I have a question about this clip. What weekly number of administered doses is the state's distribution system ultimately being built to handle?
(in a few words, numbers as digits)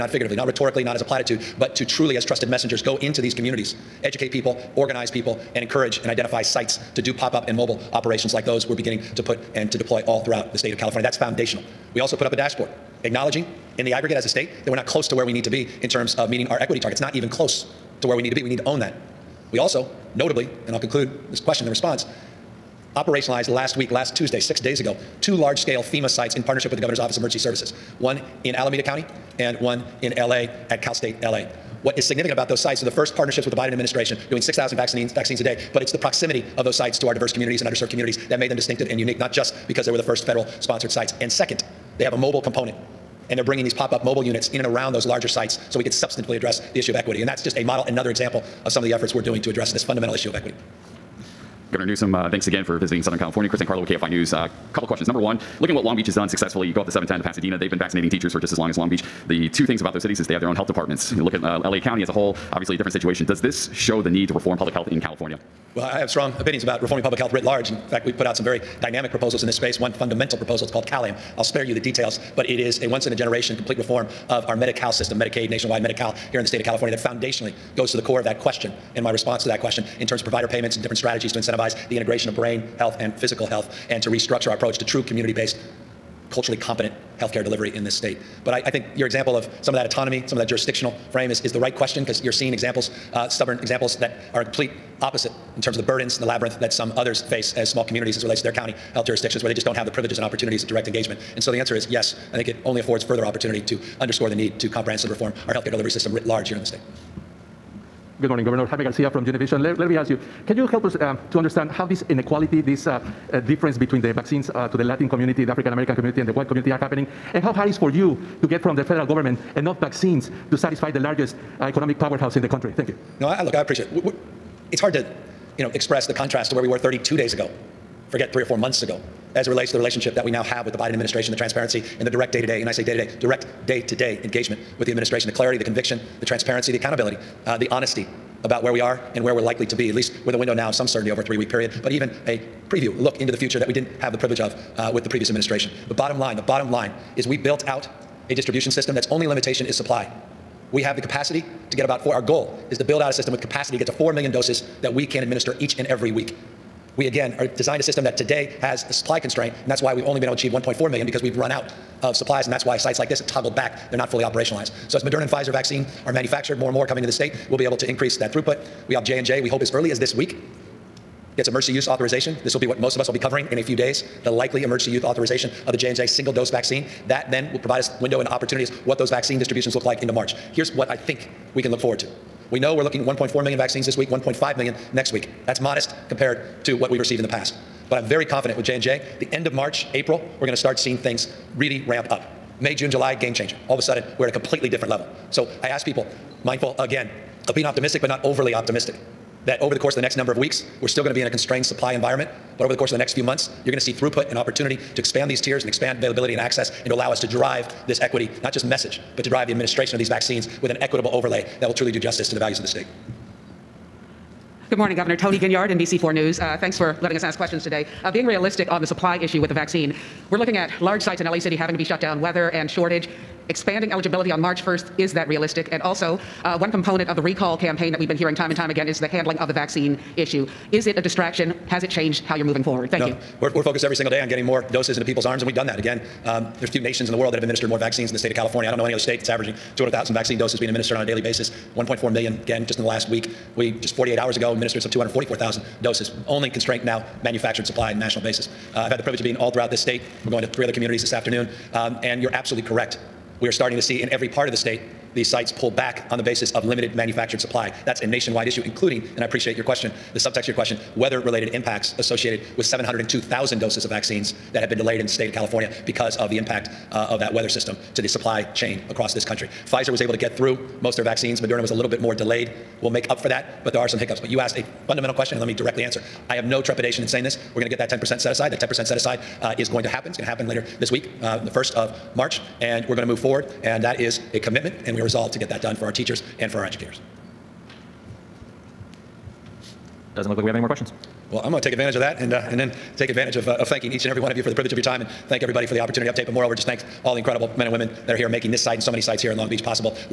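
4 million.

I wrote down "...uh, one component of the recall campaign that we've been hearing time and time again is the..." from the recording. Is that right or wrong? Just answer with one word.
right.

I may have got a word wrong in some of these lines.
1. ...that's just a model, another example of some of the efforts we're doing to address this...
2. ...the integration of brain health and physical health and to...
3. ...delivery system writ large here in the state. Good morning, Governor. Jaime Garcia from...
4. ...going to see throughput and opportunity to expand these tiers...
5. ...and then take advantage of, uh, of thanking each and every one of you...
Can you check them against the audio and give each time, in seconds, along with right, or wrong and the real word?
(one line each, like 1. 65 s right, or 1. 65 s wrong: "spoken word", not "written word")
1. 47 s right
2. 81 s right
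3. 105 s right
4. 203 s right
5. 292 s right.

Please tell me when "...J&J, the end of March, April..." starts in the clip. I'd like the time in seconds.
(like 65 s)
188 s.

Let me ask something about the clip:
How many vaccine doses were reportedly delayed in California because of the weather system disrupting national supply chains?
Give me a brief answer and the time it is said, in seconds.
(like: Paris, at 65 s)
702,000, at 262 s.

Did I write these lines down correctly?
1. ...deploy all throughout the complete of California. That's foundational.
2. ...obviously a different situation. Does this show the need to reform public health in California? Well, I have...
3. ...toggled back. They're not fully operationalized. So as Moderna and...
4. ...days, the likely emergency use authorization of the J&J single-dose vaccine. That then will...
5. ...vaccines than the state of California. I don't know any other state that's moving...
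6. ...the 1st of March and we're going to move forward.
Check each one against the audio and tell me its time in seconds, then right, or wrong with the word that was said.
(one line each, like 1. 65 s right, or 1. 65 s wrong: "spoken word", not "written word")
1. 9 s wrong: "state", not "complete"
2. 62 s right
3. 163 s right
4. 173 s right
5. 237 s wrong: "averaging", not "moving"
6. 281 s right.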